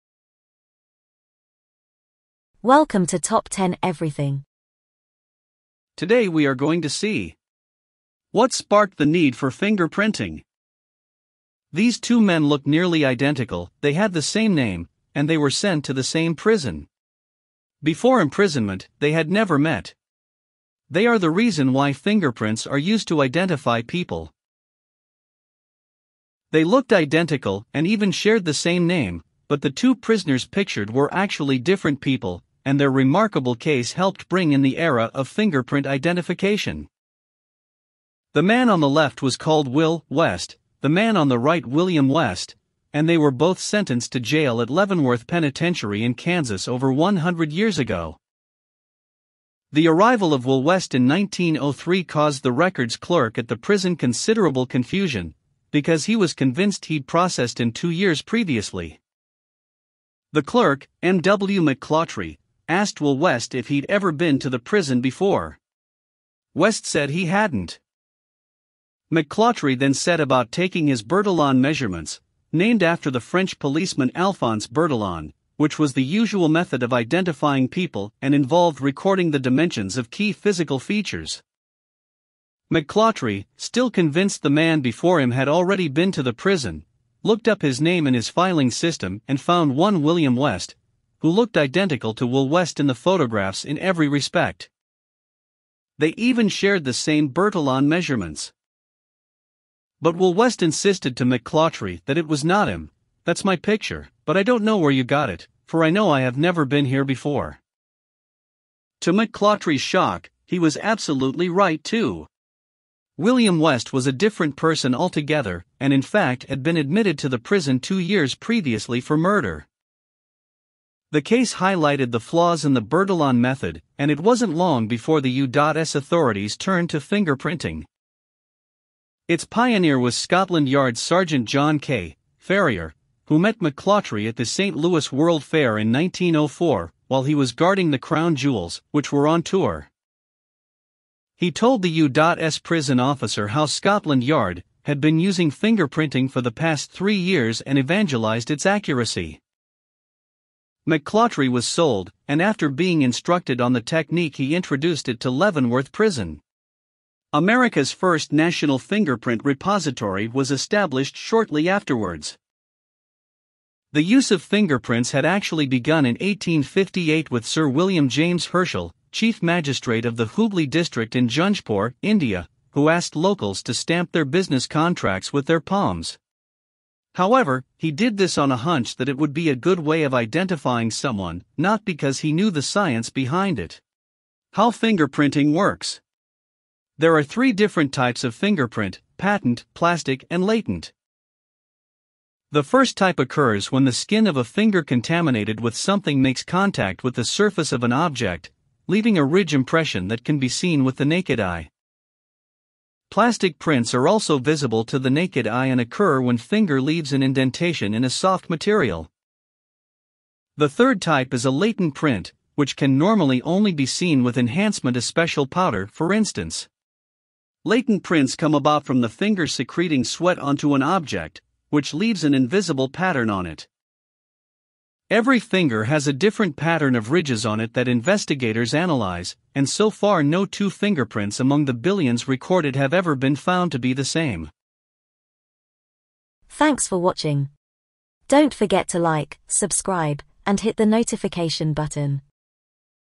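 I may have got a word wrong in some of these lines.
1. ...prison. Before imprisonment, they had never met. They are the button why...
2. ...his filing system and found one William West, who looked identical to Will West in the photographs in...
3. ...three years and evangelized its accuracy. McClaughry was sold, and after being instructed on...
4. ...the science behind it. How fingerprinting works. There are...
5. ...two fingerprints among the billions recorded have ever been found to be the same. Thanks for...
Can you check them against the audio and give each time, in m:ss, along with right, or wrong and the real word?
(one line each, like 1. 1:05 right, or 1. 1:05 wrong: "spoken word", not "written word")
1. 0:16 wrong: "reason", not "button"
2. 1:28 right
3. 2:26 right
4. 3:02 right
5. 3:50 right.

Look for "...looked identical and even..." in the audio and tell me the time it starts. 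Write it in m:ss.
0:26.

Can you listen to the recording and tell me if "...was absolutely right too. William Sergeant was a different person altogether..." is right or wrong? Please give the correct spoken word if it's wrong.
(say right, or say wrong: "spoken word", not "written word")
wrong: "West", not "Sergeant".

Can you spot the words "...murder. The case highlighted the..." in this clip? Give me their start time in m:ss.
1:59.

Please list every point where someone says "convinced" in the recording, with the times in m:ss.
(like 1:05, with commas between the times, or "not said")
0:56, 1:23.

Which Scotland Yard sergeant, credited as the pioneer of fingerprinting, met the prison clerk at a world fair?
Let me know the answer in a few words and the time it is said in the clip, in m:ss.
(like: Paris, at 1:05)
John K. Ferrier, at 2:11.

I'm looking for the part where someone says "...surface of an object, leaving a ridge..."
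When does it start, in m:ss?
3:17.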